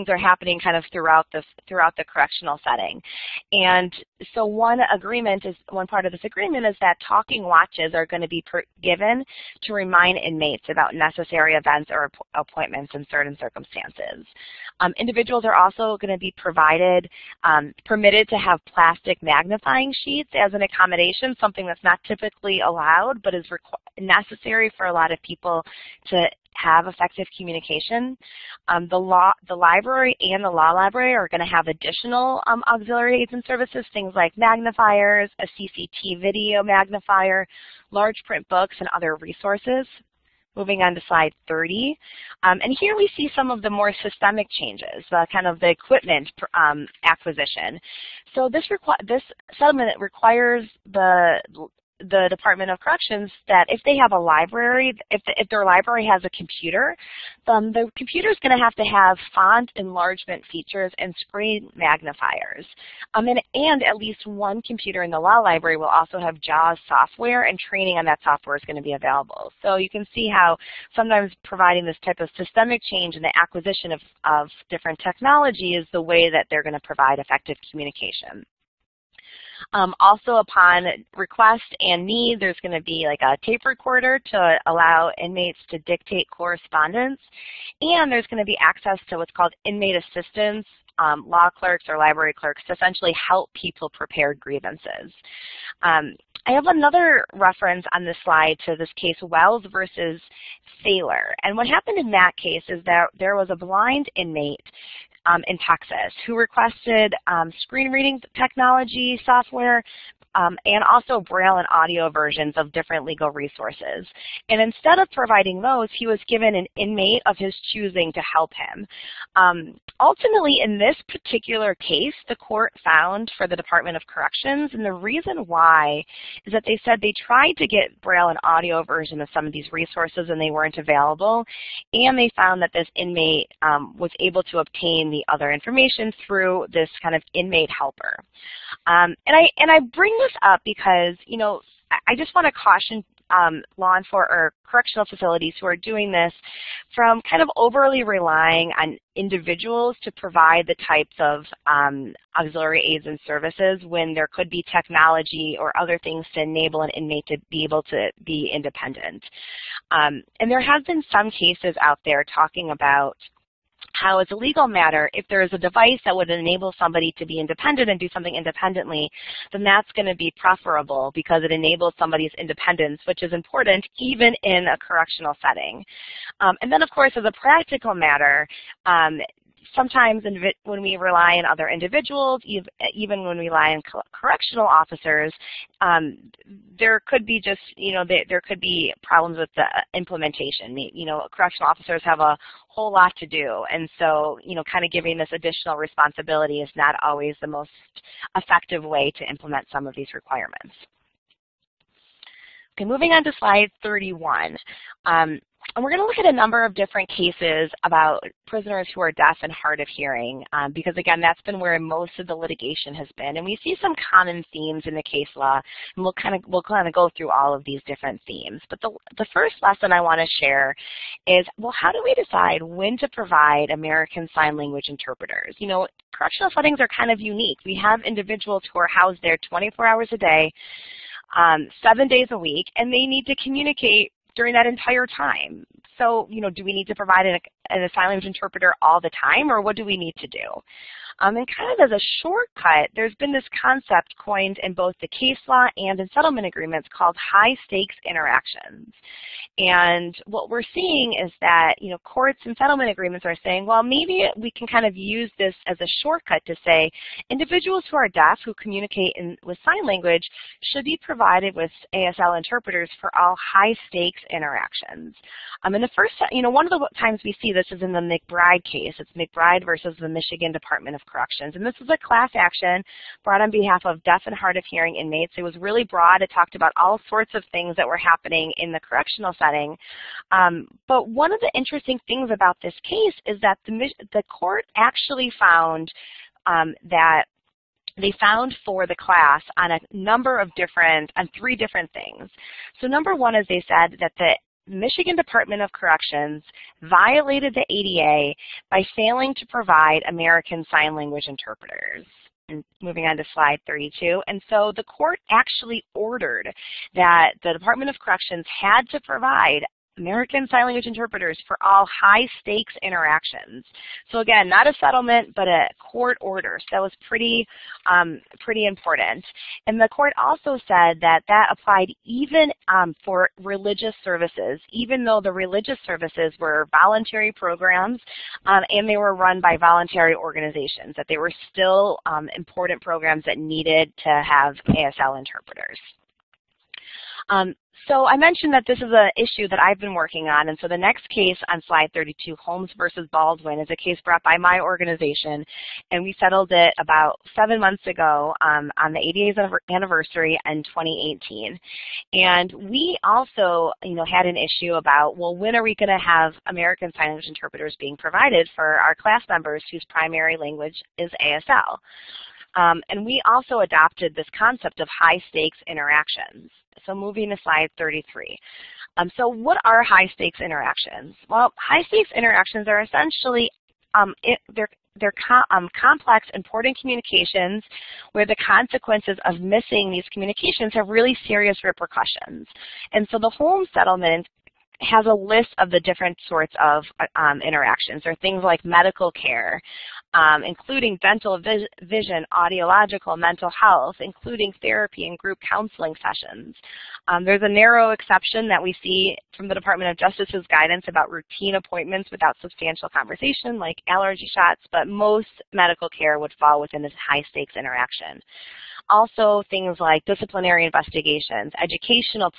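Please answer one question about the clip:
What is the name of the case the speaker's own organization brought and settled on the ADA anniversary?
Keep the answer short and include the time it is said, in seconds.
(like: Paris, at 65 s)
Holmes versus Baldwin, at 342 s.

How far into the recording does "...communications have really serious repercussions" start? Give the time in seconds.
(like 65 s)
380 s.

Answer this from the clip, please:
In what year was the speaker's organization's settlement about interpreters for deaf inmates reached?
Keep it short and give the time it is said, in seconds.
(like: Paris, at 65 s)
2018, at 350 s.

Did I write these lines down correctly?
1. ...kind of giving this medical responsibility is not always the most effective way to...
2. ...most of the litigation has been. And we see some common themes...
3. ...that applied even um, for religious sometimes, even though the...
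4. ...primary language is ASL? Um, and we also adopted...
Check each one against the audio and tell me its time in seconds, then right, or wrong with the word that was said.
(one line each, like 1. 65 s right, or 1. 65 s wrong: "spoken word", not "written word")
1. 194 s wrong: "additional", not "medical"
2. 211 s right
3. 321 s wrong: "services", not "sometimes"
4. 359 s right.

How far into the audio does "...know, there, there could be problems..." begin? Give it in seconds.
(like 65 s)
187 s.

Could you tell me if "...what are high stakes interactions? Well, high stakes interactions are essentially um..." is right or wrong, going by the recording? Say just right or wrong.
right.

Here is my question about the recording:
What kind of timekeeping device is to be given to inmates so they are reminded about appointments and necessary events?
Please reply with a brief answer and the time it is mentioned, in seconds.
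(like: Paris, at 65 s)
Talking watches, at 7 s.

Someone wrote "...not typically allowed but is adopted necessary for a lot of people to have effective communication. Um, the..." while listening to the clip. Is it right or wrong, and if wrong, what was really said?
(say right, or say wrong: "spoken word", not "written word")
wrong: "required", not "adopted".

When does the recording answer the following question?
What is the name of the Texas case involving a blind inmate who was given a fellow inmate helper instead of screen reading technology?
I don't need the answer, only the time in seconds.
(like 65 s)
99 s.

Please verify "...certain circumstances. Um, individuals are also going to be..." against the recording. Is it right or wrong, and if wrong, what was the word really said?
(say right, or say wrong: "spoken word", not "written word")
right.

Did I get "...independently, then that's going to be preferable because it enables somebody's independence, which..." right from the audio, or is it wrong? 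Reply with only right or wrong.
right.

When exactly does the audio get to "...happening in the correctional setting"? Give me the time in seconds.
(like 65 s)
277 s.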